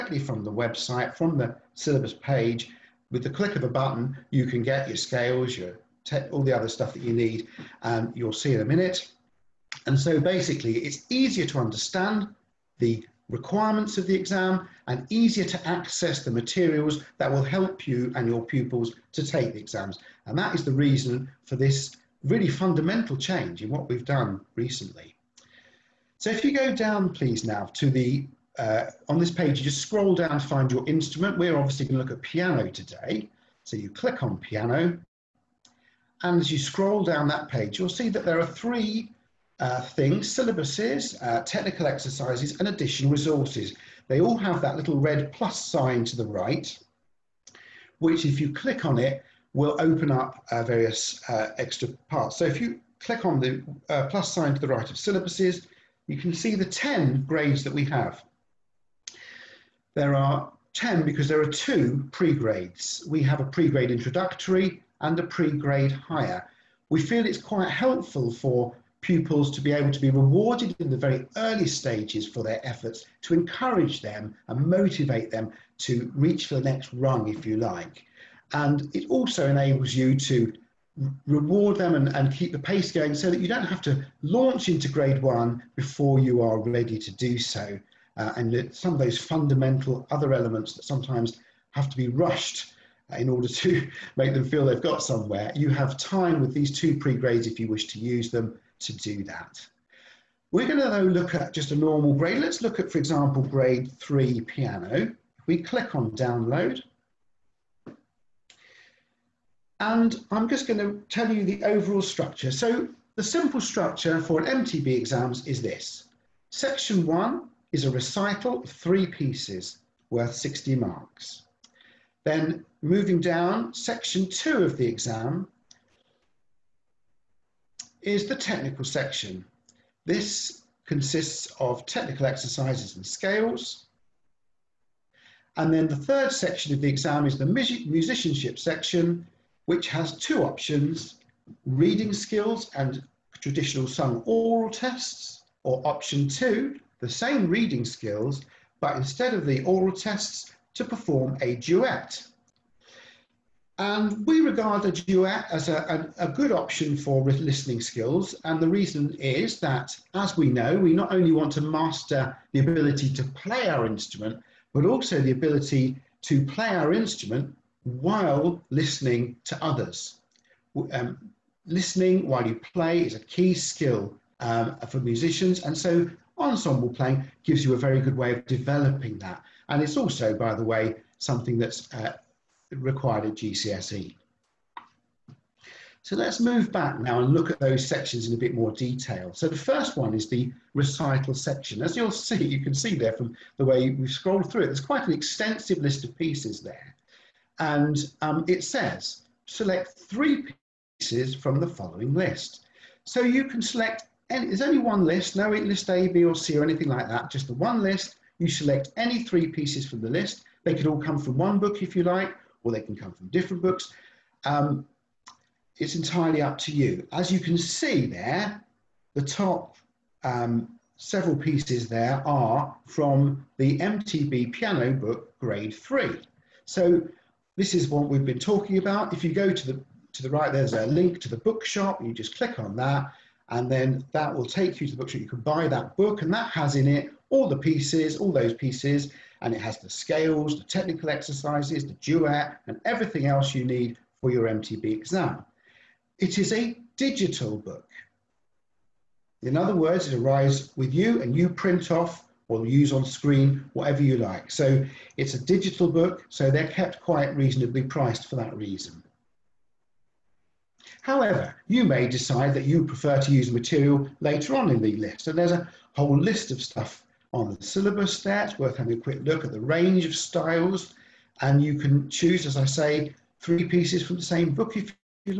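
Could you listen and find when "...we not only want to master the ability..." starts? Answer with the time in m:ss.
2:40.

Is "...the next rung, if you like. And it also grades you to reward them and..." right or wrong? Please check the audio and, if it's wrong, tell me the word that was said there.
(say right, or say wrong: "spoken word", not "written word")
wrong: "enables", not "grades".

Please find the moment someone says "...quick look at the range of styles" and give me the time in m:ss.
4:29.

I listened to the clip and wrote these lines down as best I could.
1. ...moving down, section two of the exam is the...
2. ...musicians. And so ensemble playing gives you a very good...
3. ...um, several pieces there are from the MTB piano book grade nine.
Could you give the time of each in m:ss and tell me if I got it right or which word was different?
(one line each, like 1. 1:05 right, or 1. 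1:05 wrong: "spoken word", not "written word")
1. 2:02 right
2. 2:54 right
3. 3:40 wrong: "three", not "nine".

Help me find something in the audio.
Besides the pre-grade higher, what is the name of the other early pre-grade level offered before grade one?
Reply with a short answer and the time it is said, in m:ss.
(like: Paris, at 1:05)
Pre-grade introductory, at 1:03.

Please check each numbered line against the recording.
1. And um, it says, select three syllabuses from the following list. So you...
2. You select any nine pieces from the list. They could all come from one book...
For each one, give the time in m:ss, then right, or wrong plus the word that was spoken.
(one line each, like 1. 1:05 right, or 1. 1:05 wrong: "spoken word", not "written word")
1. 3:17 wrong: "pieces", not "syllabuses"
2. 3:28 wrong: "three", not "nine".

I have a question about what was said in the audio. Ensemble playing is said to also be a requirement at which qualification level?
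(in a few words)
GCSE.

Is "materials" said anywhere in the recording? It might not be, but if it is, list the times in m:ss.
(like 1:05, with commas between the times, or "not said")
0:16, 4:23.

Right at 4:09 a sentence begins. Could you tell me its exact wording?
In other words, it arrives with you and you print off or use on screen, whatever you like.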